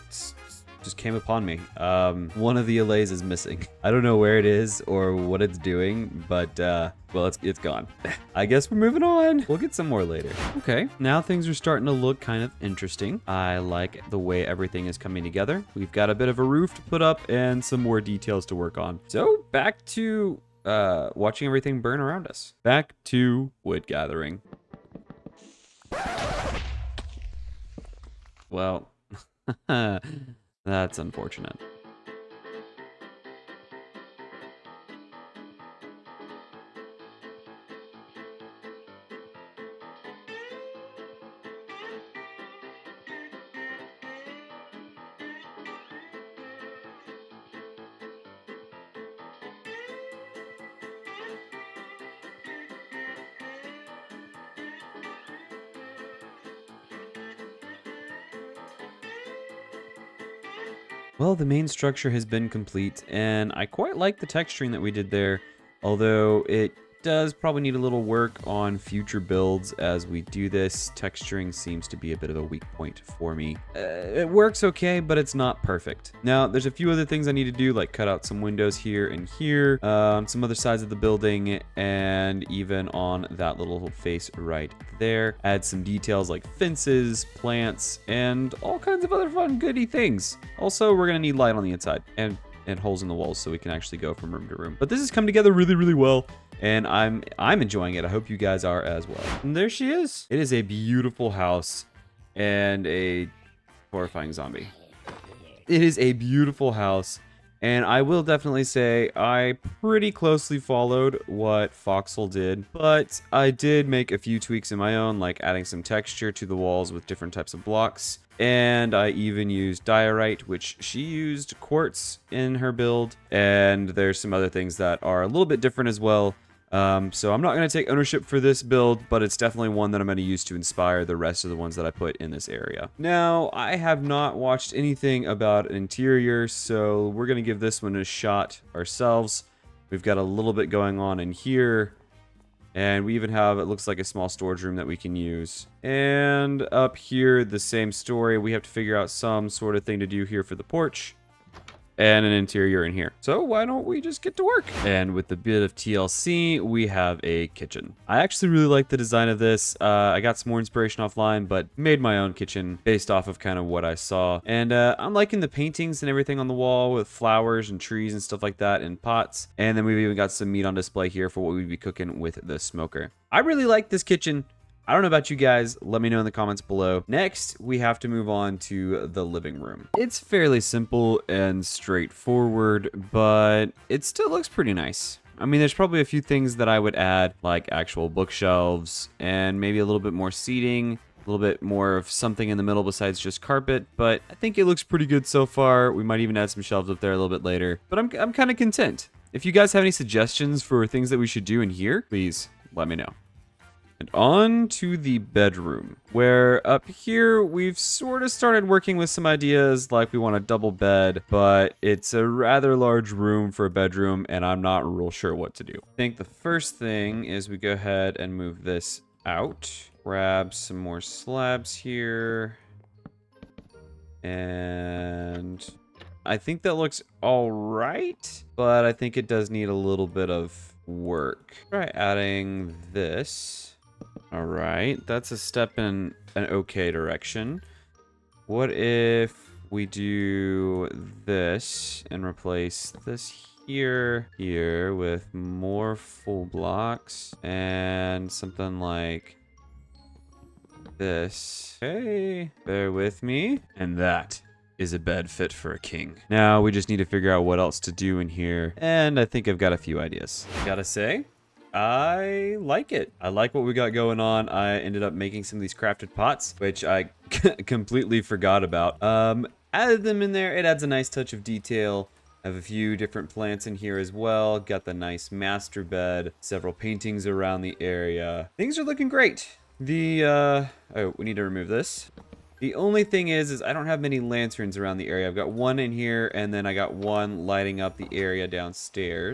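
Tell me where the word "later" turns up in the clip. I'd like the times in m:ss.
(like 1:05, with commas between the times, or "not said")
0:10, 3:17.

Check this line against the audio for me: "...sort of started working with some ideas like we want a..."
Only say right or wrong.
right.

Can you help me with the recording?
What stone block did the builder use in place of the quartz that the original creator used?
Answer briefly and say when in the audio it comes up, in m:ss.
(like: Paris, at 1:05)
diorite, at 1:59.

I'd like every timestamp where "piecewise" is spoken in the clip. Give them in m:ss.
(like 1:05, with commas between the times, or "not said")
not said.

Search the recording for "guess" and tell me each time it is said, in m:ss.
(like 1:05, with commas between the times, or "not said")
0:08.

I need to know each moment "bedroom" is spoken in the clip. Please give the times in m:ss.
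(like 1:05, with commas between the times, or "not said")
3:25, 3:33.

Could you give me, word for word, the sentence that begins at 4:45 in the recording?
I've got one in here, and then I got one lighting up the area downstairs.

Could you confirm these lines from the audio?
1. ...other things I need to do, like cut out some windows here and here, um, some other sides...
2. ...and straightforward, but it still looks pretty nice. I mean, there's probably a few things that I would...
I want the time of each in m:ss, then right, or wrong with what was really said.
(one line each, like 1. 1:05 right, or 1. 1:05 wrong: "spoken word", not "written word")
1. 1:16 right
2. 3:01 right.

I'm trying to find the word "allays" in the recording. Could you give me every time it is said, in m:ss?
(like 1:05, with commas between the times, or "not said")
0:02.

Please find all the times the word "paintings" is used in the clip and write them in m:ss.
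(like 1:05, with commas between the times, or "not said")
2:45, 4:36.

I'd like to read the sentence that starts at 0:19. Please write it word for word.
So back to uh, watching everything burn around us.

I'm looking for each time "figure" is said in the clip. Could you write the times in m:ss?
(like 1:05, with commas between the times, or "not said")
2:28, 4:17.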